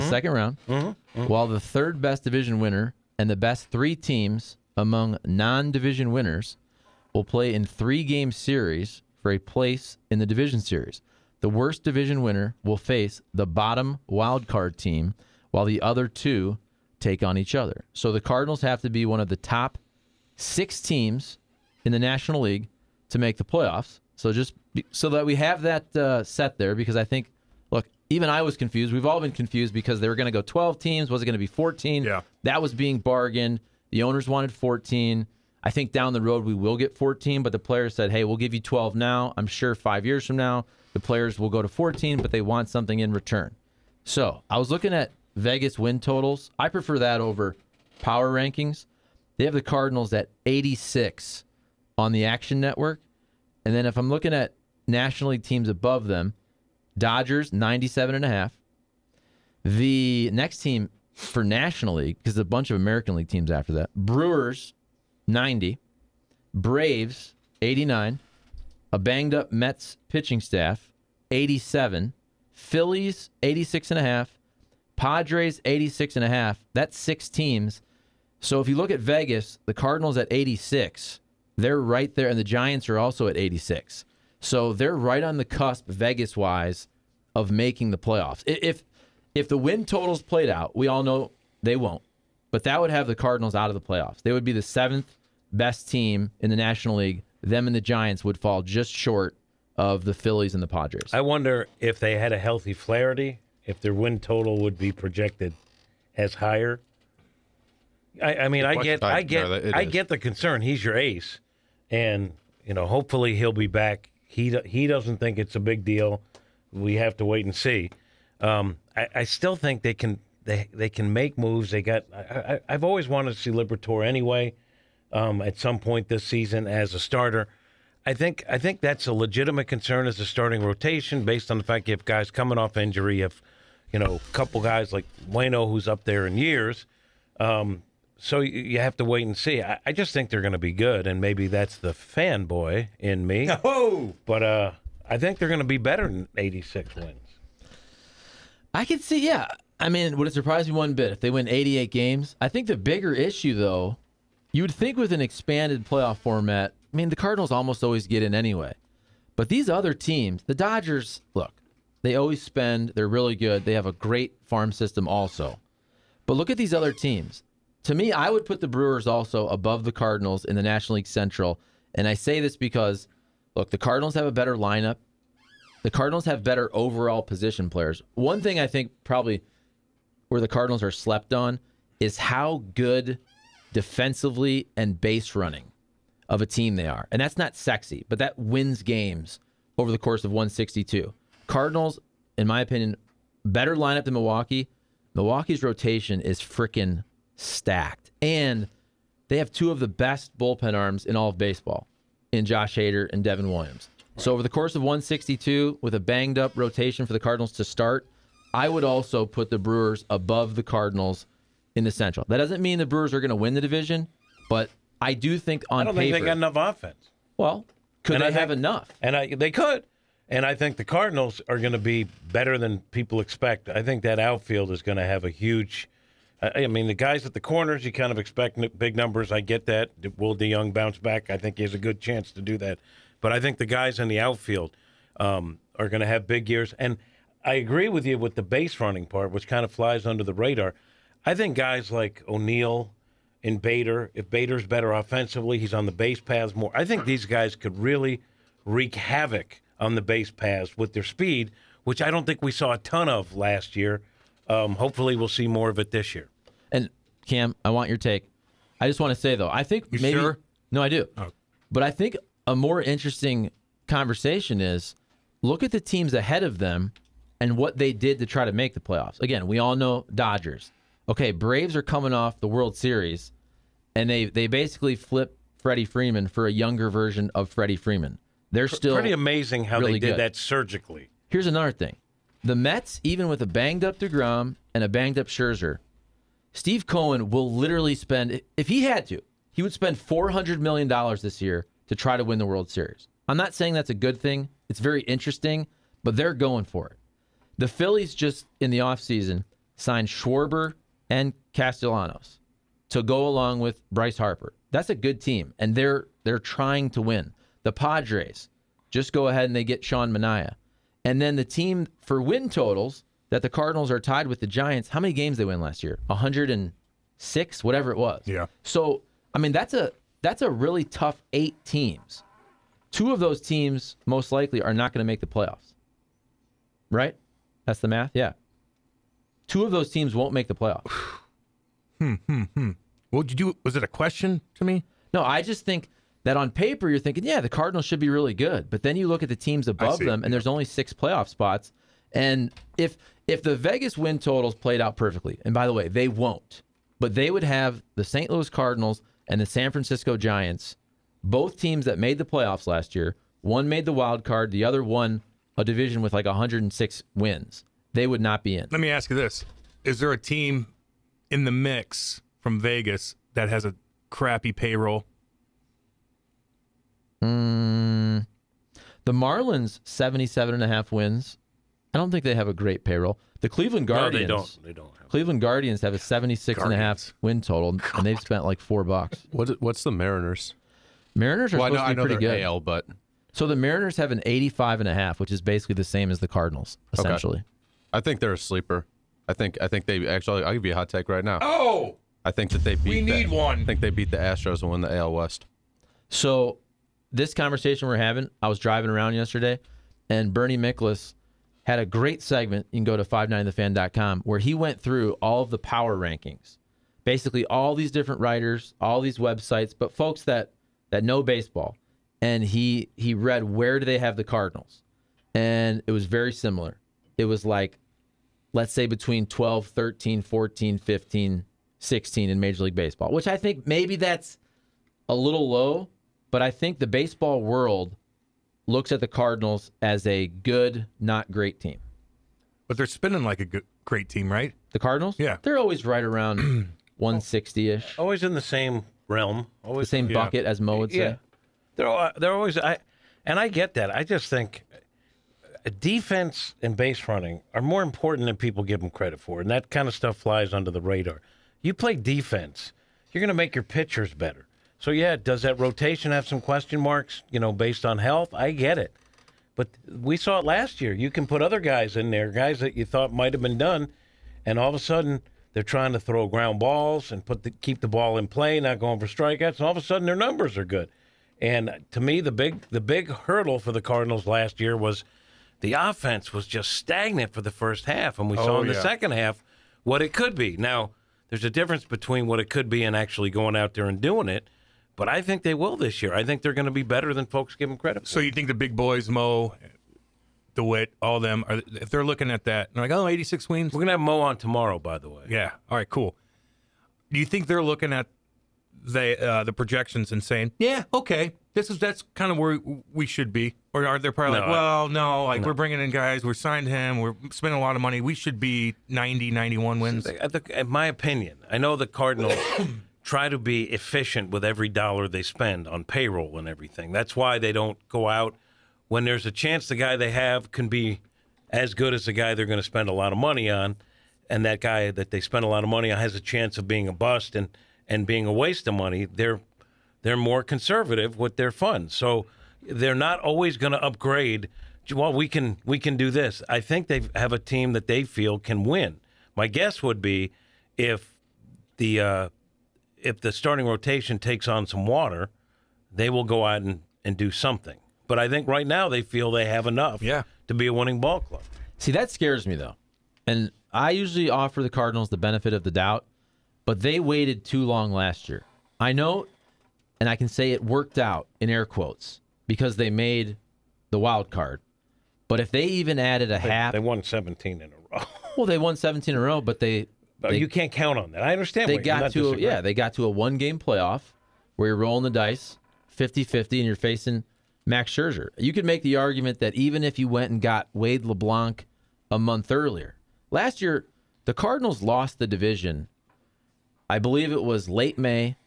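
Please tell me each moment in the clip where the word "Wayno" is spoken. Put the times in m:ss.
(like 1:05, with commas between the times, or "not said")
2:15.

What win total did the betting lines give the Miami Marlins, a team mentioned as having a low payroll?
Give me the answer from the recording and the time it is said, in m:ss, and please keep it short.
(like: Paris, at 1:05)
77.5, at 6:09.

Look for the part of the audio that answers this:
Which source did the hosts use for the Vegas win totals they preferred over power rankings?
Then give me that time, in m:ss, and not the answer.
0:52.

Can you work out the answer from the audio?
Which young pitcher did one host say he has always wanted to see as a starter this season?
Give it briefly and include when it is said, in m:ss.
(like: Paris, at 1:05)
Liberatore, at 2:03.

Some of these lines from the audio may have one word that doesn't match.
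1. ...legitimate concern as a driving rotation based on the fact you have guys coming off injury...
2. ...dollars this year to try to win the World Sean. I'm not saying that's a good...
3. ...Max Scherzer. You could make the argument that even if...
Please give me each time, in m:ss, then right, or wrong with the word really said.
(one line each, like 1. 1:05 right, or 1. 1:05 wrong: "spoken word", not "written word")
1. 2:09 wrong: "starting", not "driving"
2. 4:50 wrong: "Series", not "Sean"
3. 9:37 right.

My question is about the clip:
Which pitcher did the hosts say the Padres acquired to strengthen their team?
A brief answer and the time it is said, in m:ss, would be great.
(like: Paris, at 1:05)
Sean Manaea, at 5:09.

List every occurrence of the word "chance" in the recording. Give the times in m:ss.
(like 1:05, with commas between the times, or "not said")
3:51, 8:39, 8:46.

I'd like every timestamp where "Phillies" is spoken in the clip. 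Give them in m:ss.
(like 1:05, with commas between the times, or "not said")
1:12, 1:40, 4:57.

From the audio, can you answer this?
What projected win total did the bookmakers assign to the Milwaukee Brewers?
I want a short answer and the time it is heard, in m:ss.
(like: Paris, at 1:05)
90, at 1:03.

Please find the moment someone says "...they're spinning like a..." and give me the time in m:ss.
7:12.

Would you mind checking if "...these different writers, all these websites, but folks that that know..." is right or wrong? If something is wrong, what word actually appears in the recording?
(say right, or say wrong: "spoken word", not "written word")
right.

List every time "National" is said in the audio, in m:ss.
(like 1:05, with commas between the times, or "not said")
0:21, 0:54, 1:01, 1:36, 2:50.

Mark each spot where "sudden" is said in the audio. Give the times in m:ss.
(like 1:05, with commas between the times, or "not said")
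7:44, 7:49.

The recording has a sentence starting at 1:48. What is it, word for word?
I, I mean, I get, I get, I get, I get the concern.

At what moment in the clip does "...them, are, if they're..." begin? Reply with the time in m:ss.
8:11.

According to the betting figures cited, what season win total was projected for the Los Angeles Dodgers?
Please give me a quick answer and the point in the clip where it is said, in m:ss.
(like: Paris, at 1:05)
97.5, at 0:57.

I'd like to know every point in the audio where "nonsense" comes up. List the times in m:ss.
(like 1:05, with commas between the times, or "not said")
not said.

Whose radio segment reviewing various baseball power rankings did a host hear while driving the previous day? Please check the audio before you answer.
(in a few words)
Bernie Miklasz.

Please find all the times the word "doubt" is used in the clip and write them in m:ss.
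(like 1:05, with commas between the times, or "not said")
9:15.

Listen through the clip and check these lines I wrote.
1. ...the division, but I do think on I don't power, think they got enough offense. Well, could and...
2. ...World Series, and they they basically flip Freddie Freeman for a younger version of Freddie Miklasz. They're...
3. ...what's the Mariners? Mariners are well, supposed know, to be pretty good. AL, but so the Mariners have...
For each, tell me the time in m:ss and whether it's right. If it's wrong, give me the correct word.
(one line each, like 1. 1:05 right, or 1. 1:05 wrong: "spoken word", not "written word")
1. 3:33 wrong: "paper", not "power"
2. 4:32 wrong: "Freeman", not "Miklasz"
3. 6:19 right.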